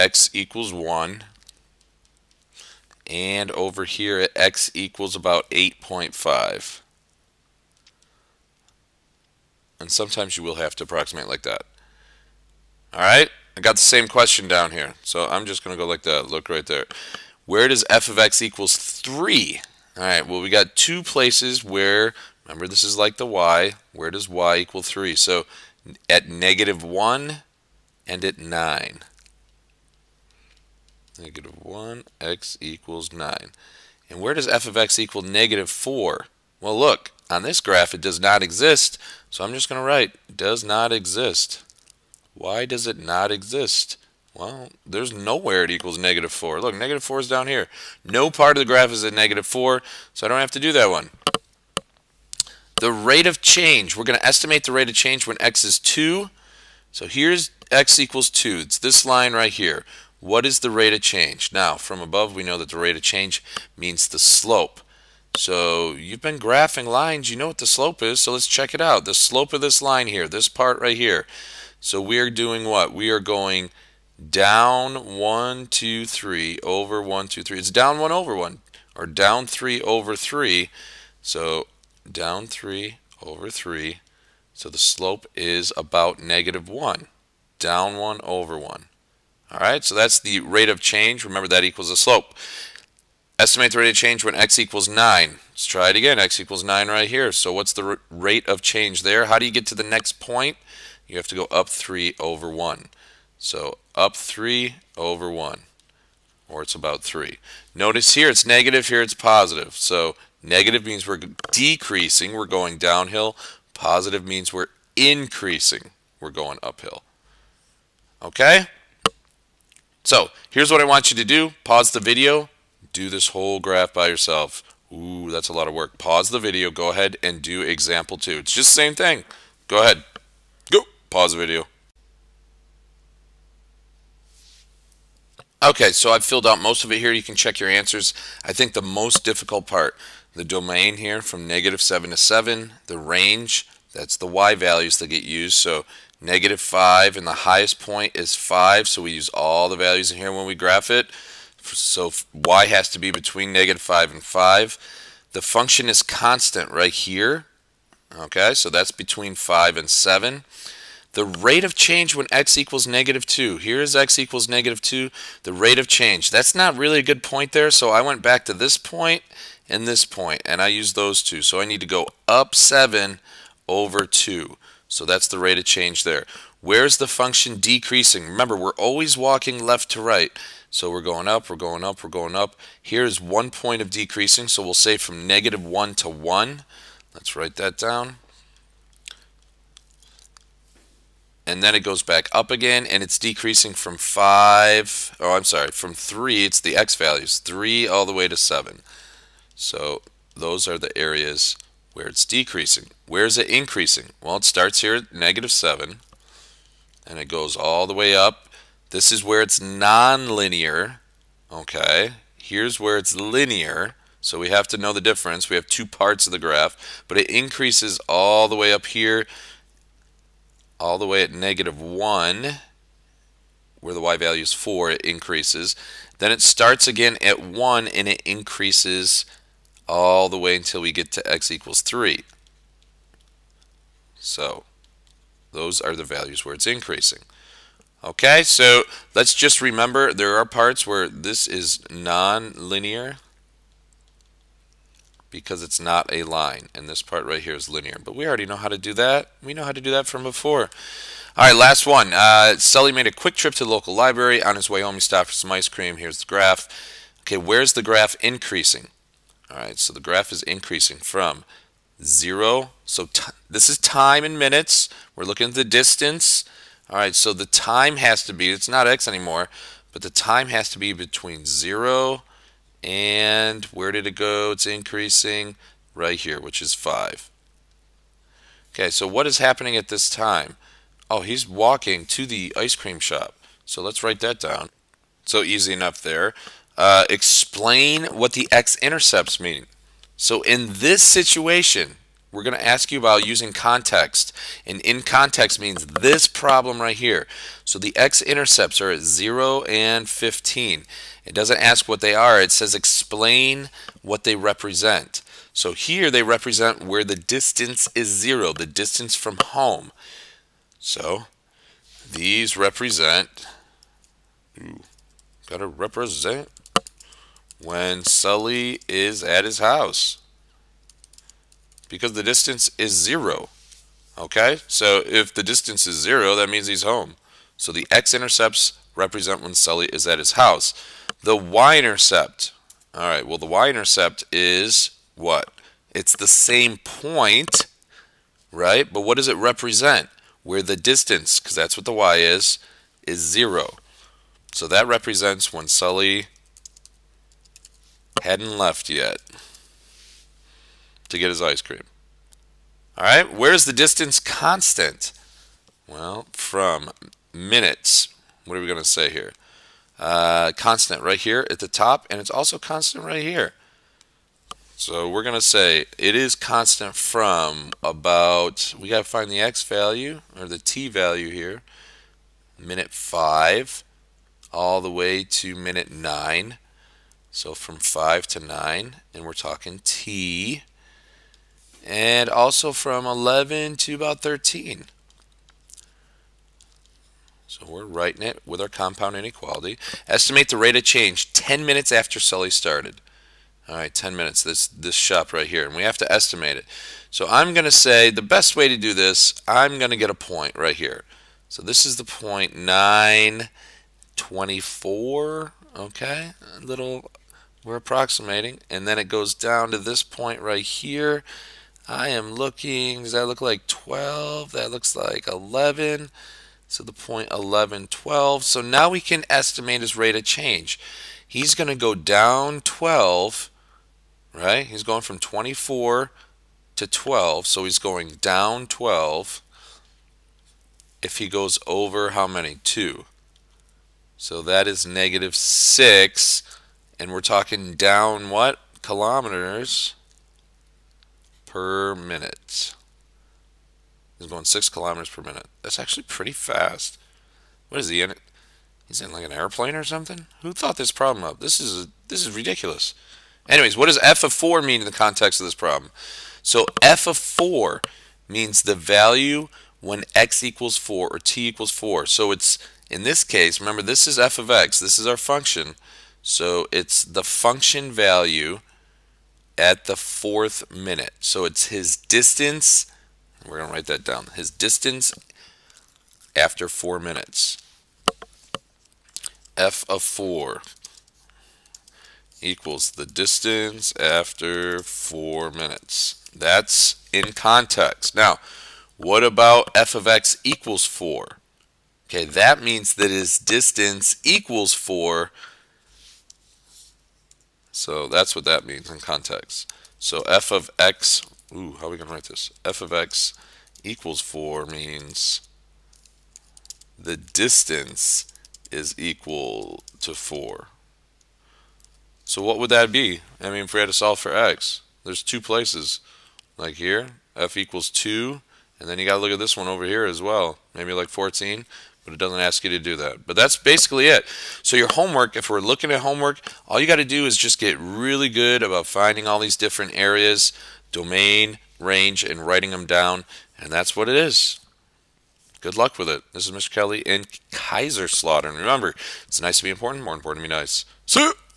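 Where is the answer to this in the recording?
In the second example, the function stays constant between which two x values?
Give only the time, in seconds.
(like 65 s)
158 s.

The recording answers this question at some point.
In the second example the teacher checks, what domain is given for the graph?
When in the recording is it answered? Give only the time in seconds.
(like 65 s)
141 s.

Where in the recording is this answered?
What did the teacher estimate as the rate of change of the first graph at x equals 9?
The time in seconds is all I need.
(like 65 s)
106 s.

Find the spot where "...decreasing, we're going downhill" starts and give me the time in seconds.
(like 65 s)
111 s.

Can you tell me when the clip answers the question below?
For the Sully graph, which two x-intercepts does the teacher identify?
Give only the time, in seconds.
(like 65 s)
299 s.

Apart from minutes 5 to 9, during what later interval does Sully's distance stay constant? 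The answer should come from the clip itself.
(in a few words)
11 to 13.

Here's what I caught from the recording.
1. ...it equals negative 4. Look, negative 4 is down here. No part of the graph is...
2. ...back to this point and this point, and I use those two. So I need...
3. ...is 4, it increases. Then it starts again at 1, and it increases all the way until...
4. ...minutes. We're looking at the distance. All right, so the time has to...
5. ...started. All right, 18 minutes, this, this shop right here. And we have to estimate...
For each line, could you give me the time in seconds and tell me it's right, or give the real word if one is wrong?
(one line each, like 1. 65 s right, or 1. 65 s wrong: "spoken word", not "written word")
1. 45 s right
2. 168 s right
3. 224 s right
4. 264 s right
5. 392 s wrong: "10", not "18".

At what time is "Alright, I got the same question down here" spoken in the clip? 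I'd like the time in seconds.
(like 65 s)
12 s.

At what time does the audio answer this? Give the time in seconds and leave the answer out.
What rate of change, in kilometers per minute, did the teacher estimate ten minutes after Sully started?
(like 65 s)
434 s.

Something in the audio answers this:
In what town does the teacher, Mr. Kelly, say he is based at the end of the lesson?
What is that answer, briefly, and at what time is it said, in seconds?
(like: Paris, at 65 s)
Kaiserslautern, at 537 s.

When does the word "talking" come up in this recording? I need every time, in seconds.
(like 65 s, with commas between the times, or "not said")
379 s, 437 s.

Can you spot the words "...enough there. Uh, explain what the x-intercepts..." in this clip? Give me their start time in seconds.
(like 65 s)
285 s.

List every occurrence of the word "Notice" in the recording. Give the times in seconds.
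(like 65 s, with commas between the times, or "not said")
107 s.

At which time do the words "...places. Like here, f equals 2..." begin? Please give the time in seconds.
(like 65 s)
515 s.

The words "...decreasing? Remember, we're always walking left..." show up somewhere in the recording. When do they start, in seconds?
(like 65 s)
177 s.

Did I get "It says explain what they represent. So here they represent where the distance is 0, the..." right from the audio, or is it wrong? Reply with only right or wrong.
right.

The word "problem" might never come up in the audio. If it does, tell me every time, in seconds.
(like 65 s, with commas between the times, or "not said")
296 s, 450 s, 455 s.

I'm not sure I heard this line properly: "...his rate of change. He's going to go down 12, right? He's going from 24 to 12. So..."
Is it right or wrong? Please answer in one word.
right.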